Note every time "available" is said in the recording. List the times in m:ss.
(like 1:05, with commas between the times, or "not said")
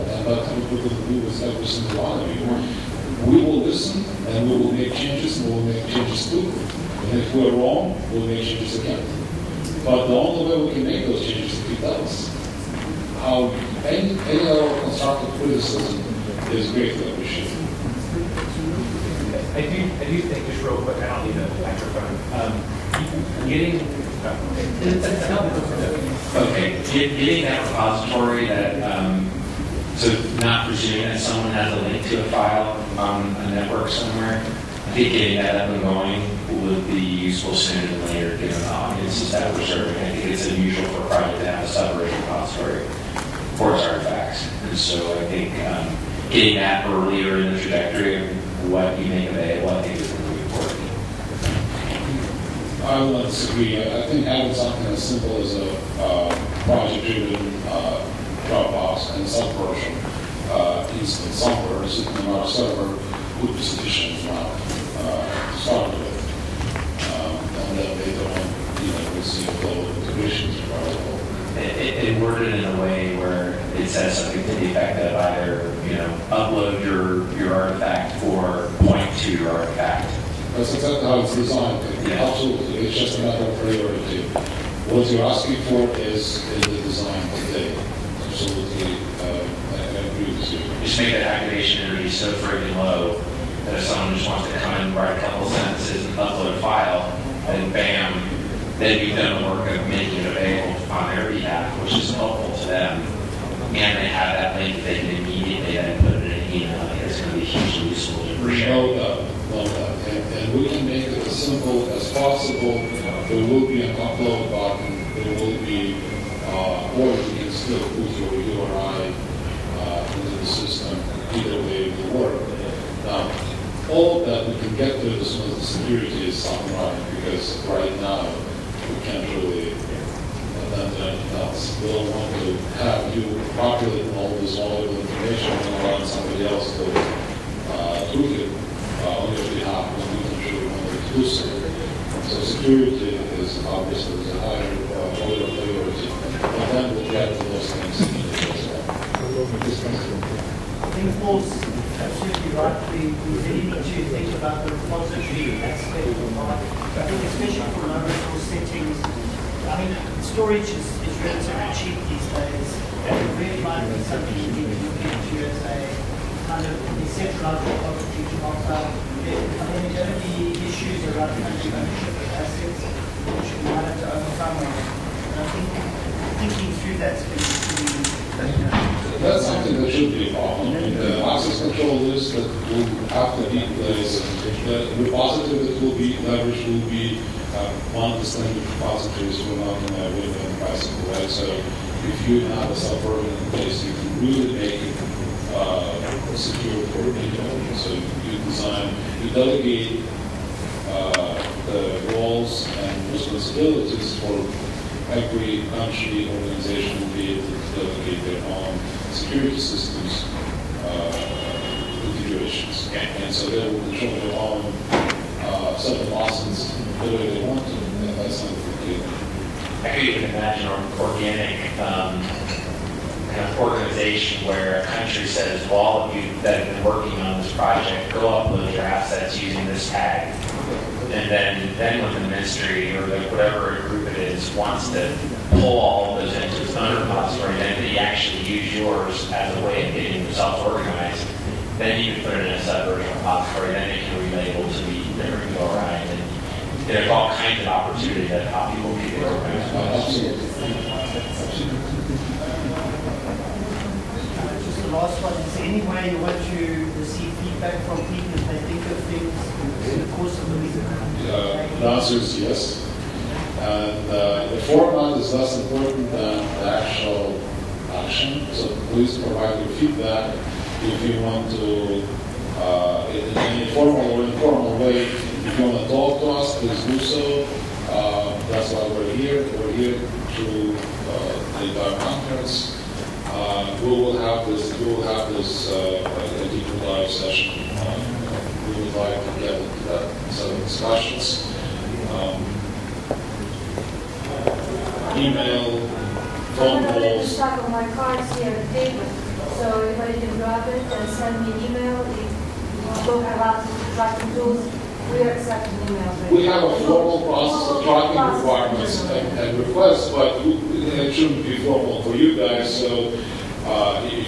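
0:49, 1:40.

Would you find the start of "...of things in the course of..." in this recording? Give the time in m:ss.
4:18.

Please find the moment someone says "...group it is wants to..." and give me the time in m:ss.
3:53.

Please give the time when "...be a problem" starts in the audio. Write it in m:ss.
3:00.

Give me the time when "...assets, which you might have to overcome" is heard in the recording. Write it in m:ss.
2:52.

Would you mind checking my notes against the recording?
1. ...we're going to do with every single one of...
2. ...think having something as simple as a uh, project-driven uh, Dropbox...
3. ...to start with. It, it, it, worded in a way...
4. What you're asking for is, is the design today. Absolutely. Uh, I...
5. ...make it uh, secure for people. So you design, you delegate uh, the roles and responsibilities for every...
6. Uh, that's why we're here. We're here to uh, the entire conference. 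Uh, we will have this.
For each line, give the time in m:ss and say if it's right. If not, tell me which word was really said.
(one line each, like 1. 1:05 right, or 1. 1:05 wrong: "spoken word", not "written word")
1. 0:00 right
2. 0:54 right
3. 1:05 right
4. 1:24 right
5. 3:14 right
6. 4:37 right.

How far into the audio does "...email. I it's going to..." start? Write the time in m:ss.
1:46.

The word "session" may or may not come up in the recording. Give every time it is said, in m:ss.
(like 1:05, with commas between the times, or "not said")
4:47.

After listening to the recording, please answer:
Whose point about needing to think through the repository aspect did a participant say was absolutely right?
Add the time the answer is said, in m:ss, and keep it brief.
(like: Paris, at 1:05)
Paul, at 2:31.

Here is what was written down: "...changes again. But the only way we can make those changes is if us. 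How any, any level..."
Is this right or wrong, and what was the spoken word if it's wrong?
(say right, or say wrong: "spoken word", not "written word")
right.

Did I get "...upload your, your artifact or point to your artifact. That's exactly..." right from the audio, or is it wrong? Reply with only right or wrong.
right.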